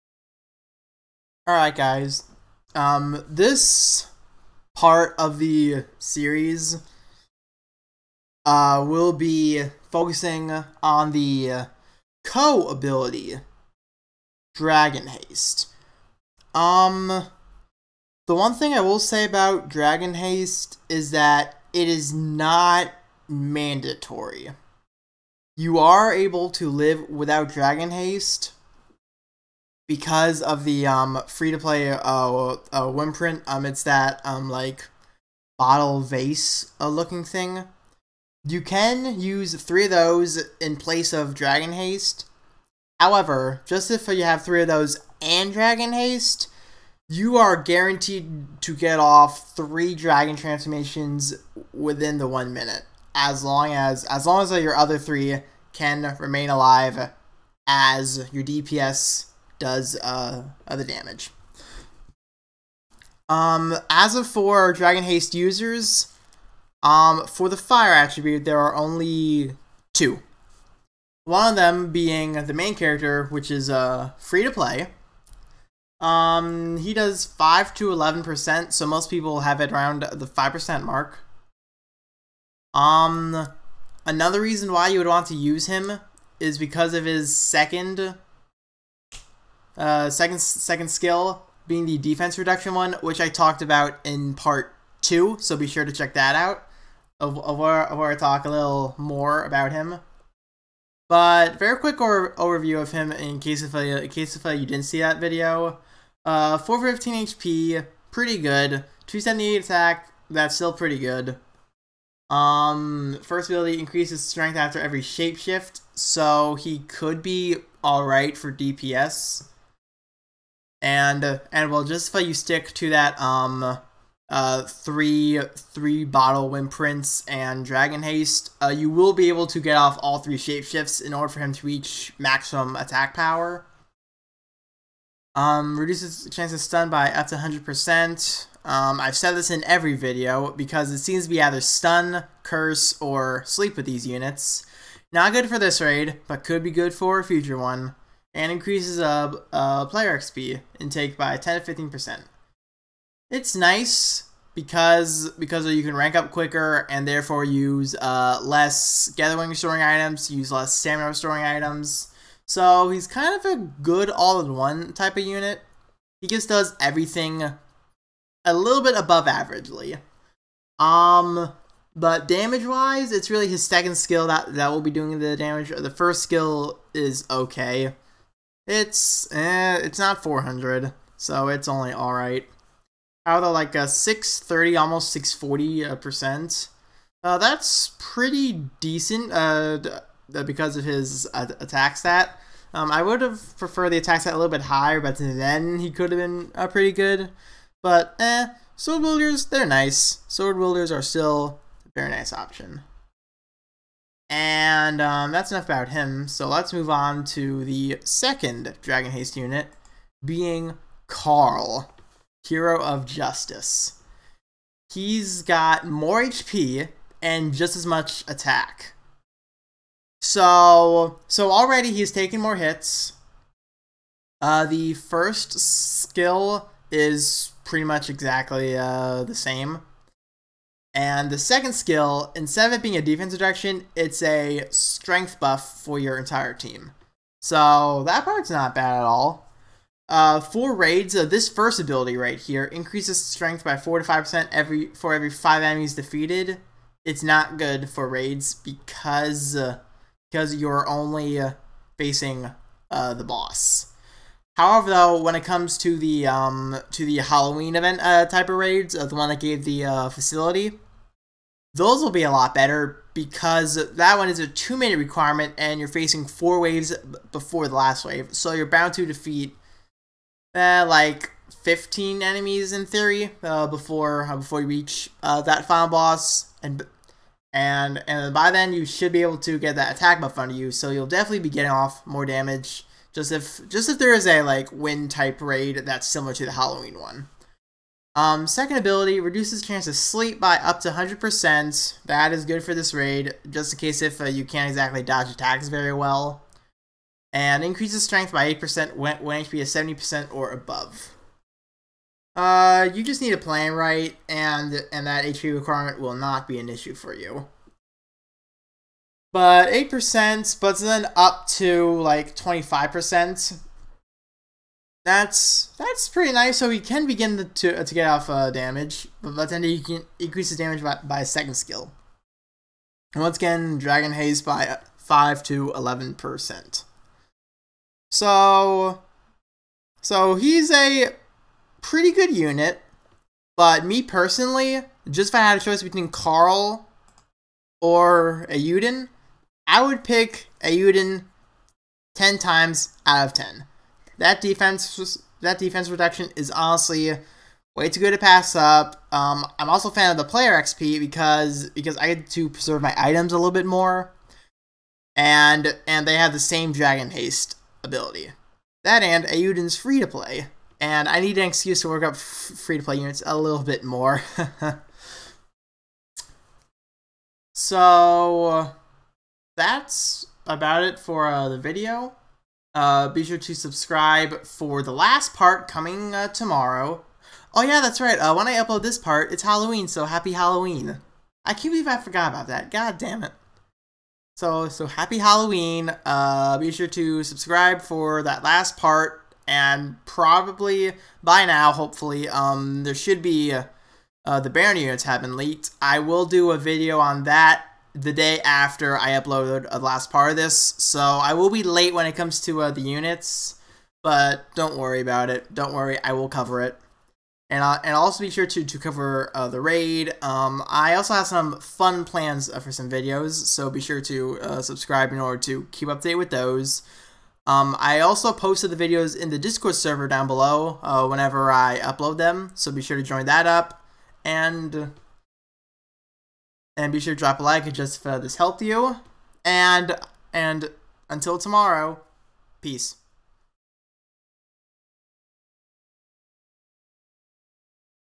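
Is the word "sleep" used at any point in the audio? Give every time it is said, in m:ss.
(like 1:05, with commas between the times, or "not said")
2:23, 4:49.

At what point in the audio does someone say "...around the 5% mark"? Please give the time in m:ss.
1:19.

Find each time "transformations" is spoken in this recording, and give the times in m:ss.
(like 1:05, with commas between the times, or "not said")
0:50.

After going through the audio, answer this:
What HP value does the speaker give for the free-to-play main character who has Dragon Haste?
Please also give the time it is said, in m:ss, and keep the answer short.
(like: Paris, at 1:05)
415, at 1:46.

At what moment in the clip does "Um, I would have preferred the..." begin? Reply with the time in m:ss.
3:12.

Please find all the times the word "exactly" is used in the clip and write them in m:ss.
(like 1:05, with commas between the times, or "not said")
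3:48, 4:54.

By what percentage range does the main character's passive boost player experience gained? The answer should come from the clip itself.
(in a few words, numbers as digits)
10 to 15%.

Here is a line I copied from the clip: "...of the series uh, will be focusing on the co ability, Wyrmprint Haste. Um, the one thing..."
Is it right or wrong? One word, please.
wrong.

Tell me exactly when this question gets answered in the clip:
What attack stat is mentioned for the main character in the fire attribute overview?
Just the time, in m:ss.
1:49.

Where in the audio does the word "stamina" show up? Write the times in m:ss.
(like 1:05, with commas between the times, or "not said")
2:40.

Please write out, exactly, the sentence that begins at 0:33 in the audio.
Um, it's that um, like bottle vase uh, looking thing.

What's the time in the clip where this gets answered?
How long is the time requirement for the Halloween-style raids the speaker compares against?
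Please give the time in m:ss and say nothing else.
4:24.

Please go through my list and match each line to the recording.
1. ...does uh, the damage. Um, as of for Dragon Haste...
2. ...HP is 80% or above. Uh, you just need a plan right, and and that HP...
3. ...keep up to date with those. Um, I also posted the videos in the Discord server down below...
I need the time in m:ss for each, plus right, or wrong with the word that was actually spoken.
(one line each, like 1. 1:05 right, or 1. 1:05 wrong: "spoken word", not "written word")
1. 0:59 right
2. 4:59 wrong: "70", not "80"
3. 6:55 right.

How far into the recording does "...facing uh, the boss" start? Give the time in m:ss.
4:11.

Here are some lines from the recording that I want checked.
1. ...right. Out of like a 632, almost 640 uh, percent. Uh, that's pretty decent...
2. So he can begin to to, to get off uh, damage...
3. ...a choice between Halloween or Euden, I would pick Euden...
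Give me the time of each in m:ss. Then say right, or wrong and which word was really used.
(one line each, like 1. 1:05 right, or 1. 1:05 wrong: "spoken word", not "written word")
1. 3:02 wrong: "630", not "632"
2. 5:16 right
3. 5:35 wrong: "Carl", not "Halloween".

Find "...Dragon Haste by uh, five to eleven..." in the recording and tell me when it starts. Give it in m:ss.
5:23.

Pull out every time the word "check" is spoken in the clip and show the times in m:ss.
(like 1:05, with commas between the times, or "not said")
1:35.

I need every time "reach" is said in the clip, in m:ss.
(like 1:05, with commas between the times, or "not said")
2:11, 4:34.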